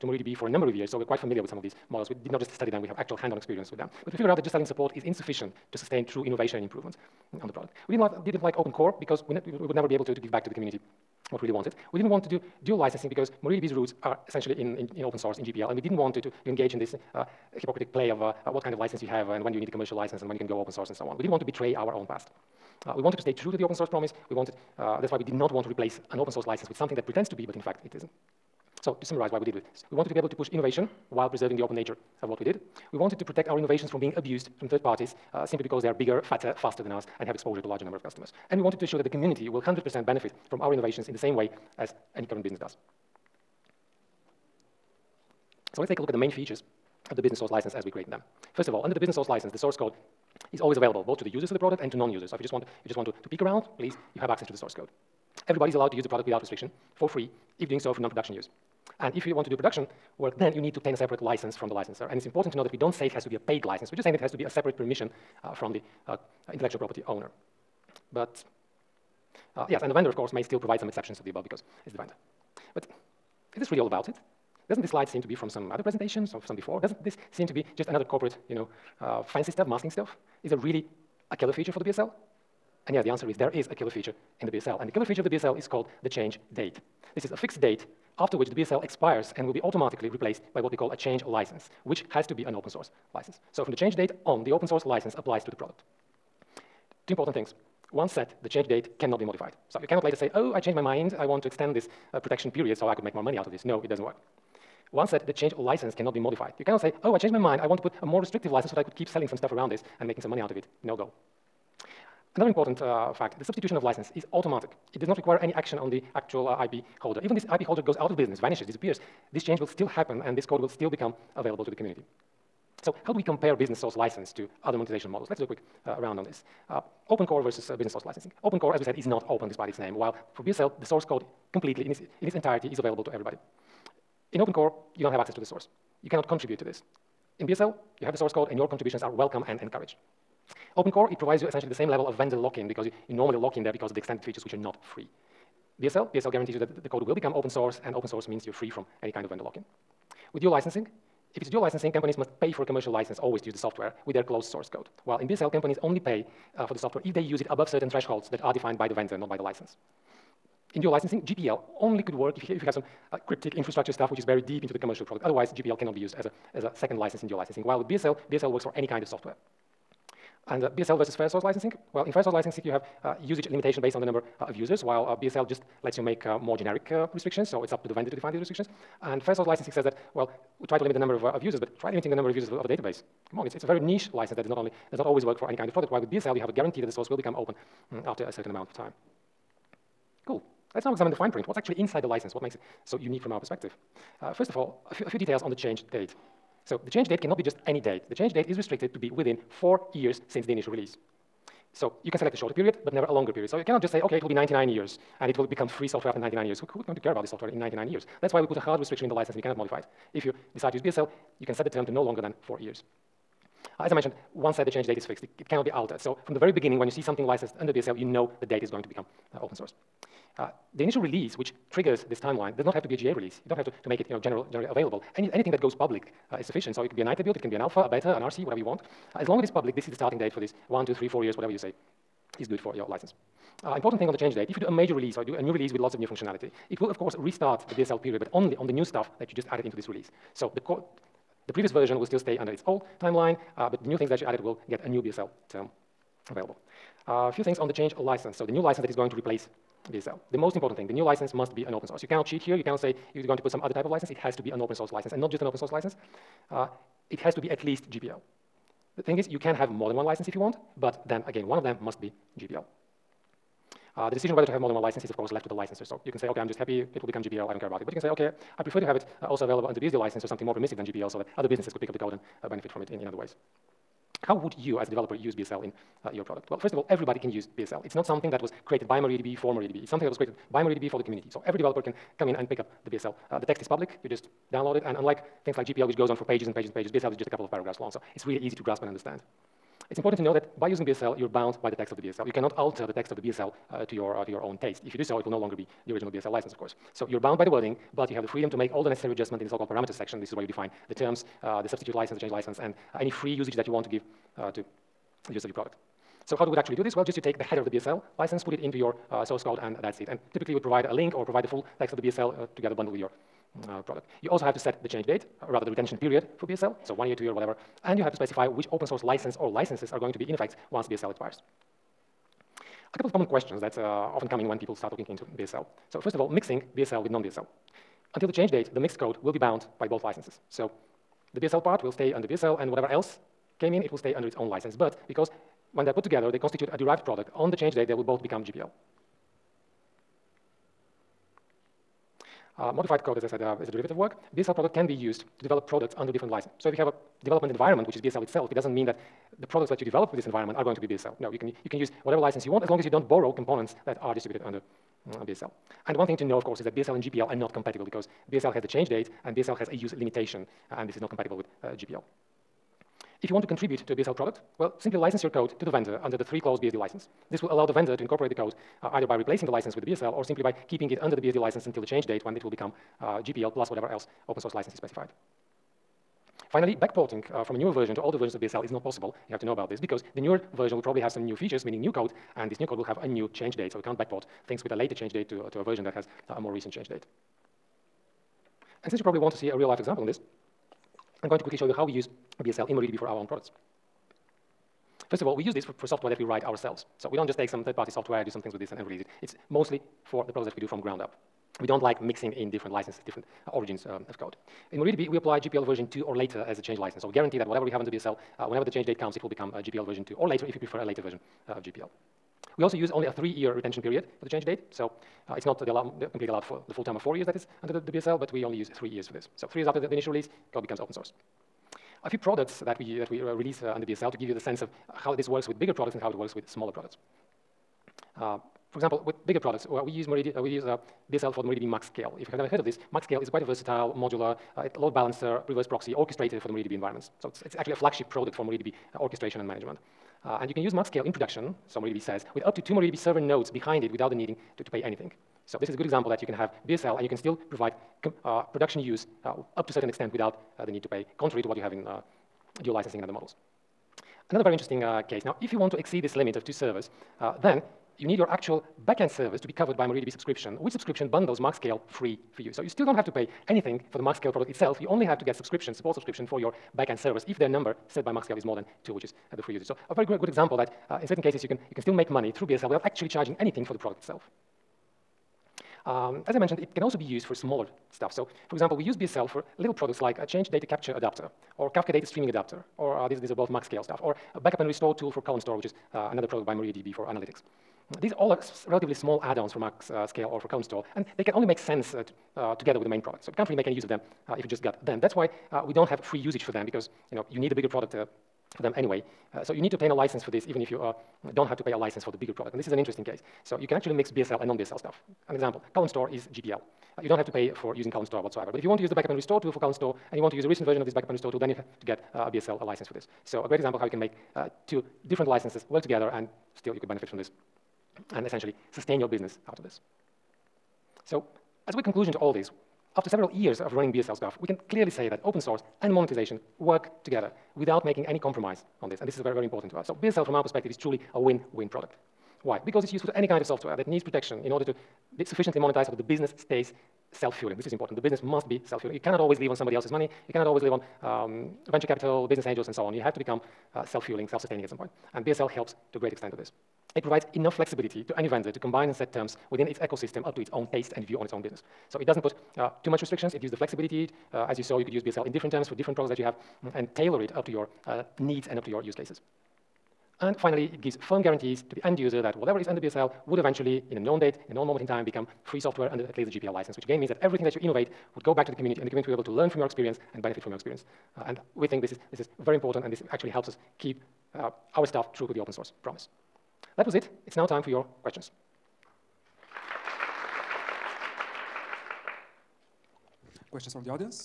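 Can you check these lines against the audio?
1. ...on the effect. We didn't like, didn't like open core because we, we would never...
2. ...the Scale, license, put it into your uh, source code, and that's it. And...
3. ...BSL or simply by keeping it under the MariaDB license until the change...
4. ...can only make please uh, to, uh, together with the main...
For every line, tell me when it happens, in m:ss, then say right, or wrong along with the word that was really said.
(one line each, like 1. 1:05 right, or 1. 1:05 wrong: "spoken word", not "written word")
1. 0:07 wrong: "product", not "effect"
2. 5:07 wrong: "BSL", not "Scale"
3. 6:09 wrong: "BSD", not "MariaDB"
4. 8:11 wrong: "sense", not "please".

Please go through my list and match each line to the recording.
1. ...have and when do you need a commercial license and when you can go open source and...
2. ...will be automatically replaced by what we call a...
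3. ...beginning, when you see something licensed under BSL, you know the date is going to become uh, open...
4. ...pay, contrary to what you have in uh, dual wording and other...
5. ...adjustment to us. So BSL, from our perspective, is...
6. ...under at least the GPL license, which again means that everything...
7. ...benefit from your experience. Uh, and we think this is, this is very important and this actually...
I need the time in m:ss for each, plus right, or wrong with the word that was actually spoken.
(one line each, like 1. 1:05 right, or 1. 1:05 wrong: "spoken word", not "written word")
1. 0:19 right
2. 1:29 right
3. 3:36 right
4. 7:30 wrong: "licensing", not "wording"
5. 8:49 wrong: "important", not "adjustment"
6. 9:25 right
7. 9:30 right.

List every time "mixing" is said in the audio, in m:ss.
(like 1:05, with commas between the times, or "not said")
5:26, 6:42.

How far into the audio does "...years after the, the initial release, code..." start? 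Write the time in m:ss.
6:59.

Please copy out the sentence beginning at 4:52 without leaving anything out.
You cannot alter the text of the BSL uh, to, your, uh, to your own taste.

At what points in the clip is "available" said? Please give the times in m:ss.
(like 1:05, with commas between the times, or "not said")
0:50, 2:01, 2:12, 3:44, 4:06, 4:29.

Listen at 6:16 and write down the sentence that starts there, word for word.
Finally, backporting uh, from a newer version to older versions of BSL is not possible.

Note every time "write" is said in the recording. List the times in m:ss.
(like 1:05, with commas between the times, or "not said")
6:36.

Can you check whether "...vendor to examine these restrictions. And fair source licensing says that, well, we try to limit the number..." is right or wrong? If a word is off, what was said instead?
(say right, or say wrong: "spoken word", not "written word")
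wrong: "define", not "examine".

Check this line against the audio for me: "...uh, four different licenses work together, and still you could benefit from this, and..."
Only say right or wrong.
wrong.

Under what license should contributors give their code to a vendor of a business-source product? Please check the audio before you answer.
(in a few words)
Three-clause BSD license.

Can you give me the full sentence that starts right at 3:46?
So it could be a nightly build, it can be an alpha, a beta, an RC, whatever you want.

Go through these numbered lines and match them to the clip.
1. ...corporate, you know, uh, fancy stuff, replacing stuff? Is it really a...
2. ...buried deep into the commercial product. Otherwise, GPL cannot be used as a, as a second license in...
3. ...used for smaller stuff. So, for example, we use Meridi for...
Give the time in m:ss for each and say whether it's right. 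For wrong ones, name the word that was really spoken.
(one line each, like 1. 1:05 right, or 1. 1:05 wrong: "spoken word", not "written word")
1. 1:18 wrong: "masking", not "replacing"
2. 2:44 right
3. 7:57 wrong: "BSL", not "Meridi".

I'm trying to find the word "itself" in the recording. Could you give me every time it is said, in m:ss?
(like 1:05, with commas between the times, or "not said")
5:48, 7:44, 7:53.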